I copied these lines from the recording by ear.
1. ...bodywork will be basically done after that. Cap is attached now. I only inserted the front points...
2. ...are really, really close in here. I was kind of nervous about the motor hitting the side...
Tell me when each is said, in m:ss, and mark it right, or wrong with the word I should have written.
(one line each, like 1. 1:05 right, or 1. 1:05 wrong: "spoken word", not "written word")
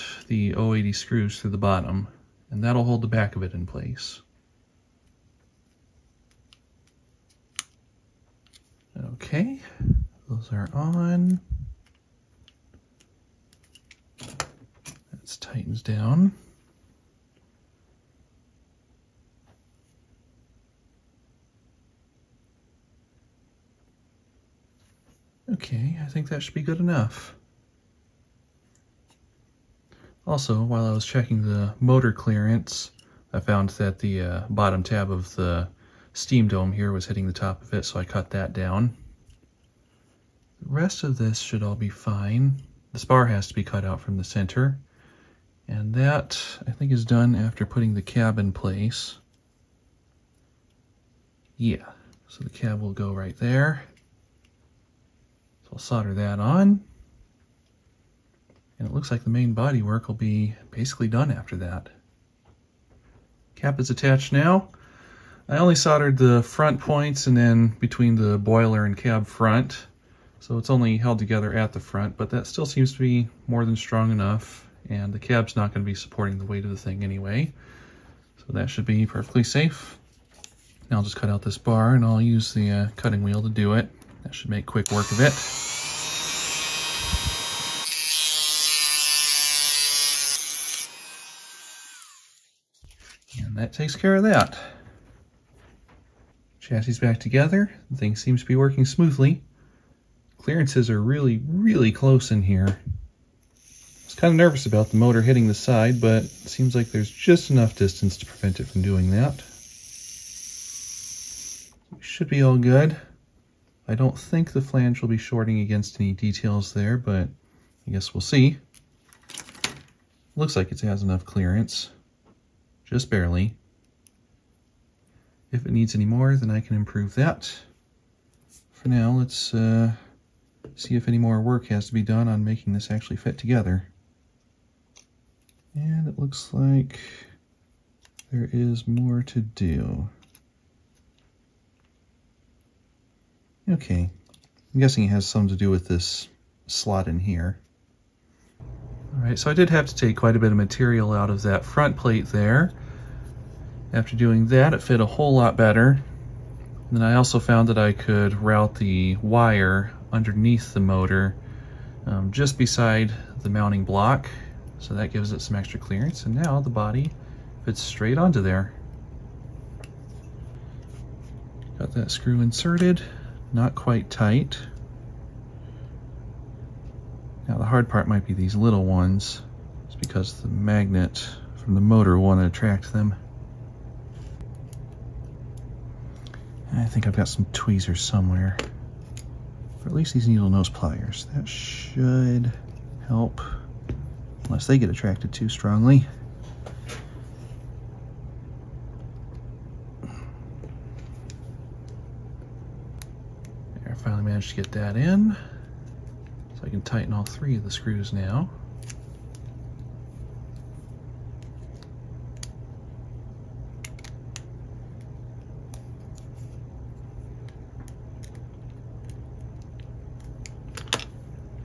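1. 0:59 wrong: "soldered", not "inserted"
2. 1:40 right.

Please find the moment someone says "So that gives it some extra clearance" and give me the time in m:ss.
2:44.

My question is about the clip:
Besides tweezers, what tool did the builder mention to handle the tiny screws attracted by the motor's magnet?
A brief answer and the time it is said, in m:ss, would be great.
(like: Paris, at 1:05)
needle nose pliers, at 3:10.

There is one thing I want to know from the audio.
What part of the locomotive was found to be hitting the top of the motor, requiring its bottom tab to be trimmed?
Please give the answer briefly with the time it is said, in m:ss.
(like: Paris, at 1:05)
steam dome, at 0:36.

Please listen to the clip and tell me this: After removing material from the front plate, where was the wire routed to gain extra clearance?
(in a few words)
underneath the motor.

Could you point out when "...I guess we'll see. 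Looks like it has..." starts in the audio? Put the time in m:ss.
1:57.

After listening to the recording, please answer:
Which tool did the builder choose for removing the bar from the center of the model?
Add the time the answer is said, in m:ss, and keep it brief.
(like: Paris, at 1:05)
cutting wheel, at 1:22.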